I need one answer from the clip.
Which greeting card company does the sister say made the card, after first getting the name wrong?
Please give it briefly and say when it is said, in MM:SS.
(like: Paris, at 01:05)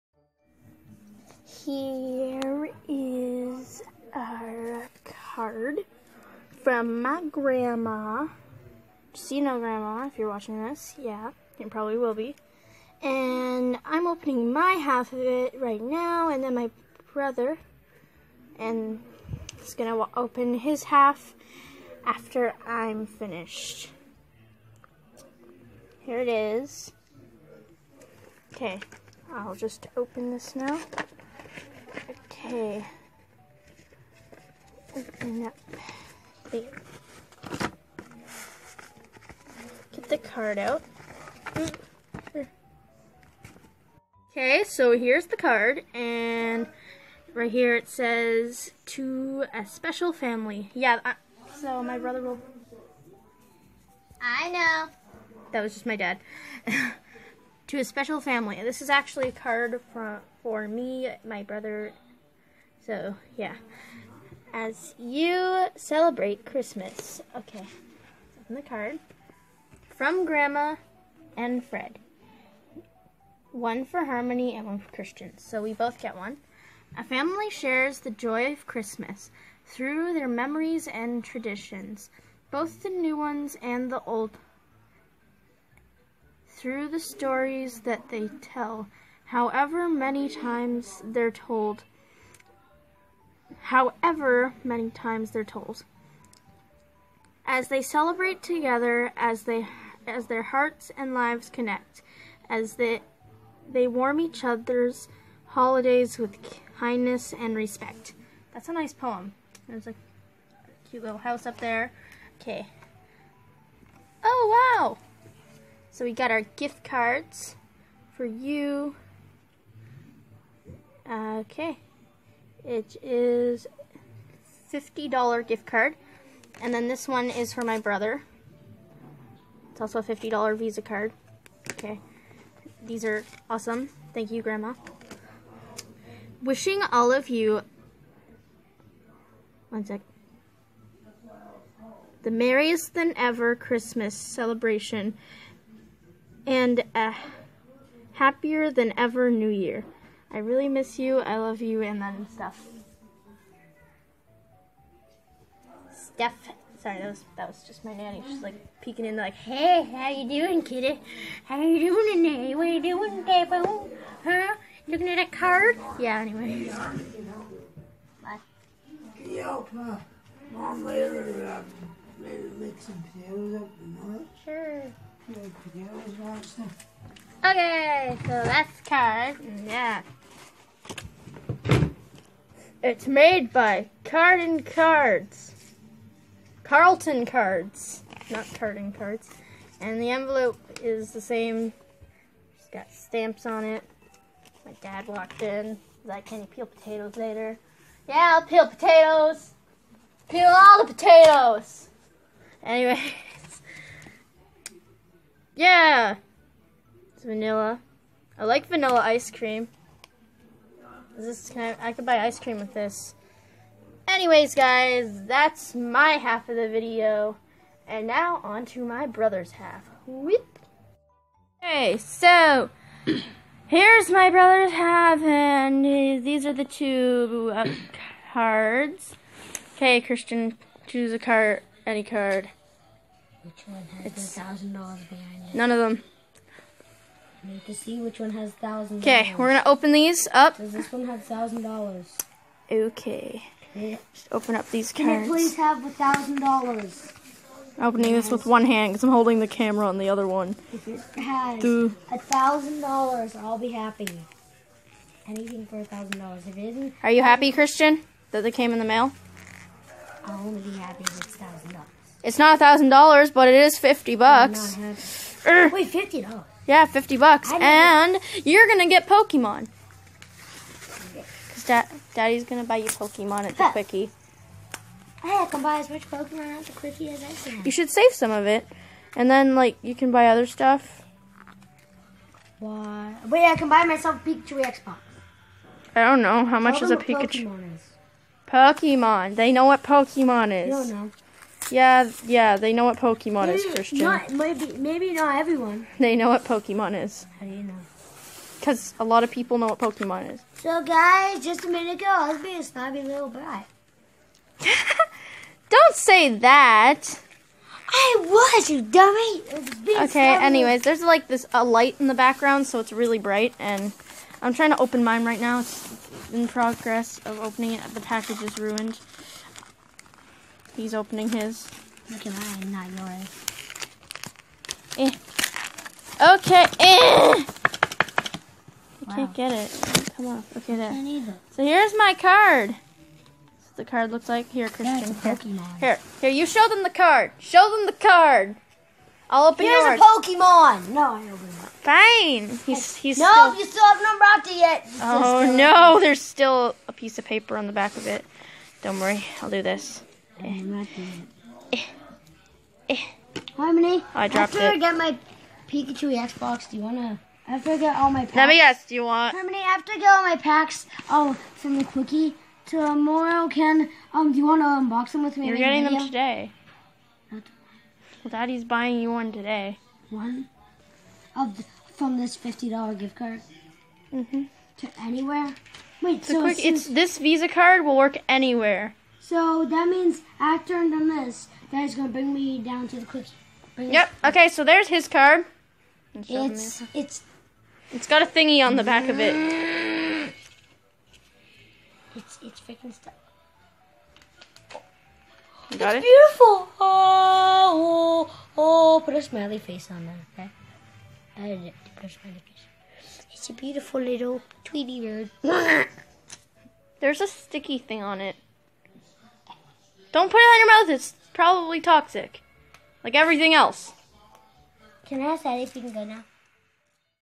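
Carlton Cards, at 03:06.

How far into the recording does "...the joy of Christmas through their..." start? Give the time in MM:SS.
01:17.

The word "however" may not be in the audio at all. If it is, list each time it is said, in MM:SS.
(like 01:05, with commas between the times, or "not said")
01:29, 01:33.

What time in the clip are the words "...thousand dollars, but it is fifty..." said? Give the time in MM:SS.
04:22.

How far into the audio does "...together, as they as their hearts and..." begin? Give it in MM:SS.
01:38.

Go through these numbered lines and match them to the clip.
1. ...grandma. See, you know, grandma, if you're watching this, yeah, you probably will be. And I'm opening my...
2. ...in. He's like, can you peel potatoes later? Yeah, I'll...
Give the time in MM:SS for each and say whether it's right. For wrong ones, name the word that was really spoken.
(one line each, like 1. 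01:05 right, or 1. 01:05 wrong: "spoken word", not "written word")
1. 00:07 right
2. 03:15 right.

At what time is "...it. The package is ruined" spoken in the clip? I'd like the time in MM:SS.
05:17.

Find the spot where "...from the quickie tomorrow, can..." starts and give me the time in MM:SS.
06:01.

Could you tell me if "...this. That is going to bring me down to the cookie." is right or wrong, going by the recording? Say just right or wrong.
right.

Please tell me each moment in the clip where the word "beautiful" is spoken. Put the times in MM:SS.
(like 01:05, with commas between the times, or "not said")
06:36, 06:43.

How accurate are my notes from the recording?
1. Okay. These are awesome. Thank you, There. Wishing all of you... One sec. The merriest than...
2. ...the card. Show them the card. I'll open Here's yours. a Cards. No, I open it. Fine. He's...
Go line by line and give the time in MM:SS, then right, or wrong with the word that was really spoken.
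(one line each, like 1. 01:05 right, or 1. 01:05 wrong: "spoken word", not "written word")
1. 02:11 wrong: "Grandma", not "There"
2. 05:36 wrong: "Pokemon", not "Cards".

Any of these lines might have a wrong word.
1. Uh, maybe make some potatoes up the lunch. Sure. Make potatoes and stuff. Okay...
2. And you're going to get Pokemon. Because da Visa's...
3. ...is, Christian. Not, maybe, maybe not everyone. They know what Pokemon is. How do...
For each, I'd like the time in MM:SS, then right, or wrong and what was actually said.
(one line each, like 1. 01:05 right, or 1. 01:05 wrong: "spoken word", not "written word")
1. 02:51 right
2. 04:27 wrong: "Daddy", not "Visa"
3. 04:53 right.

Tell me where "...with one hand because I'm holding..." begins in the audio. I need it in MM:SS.
04:08.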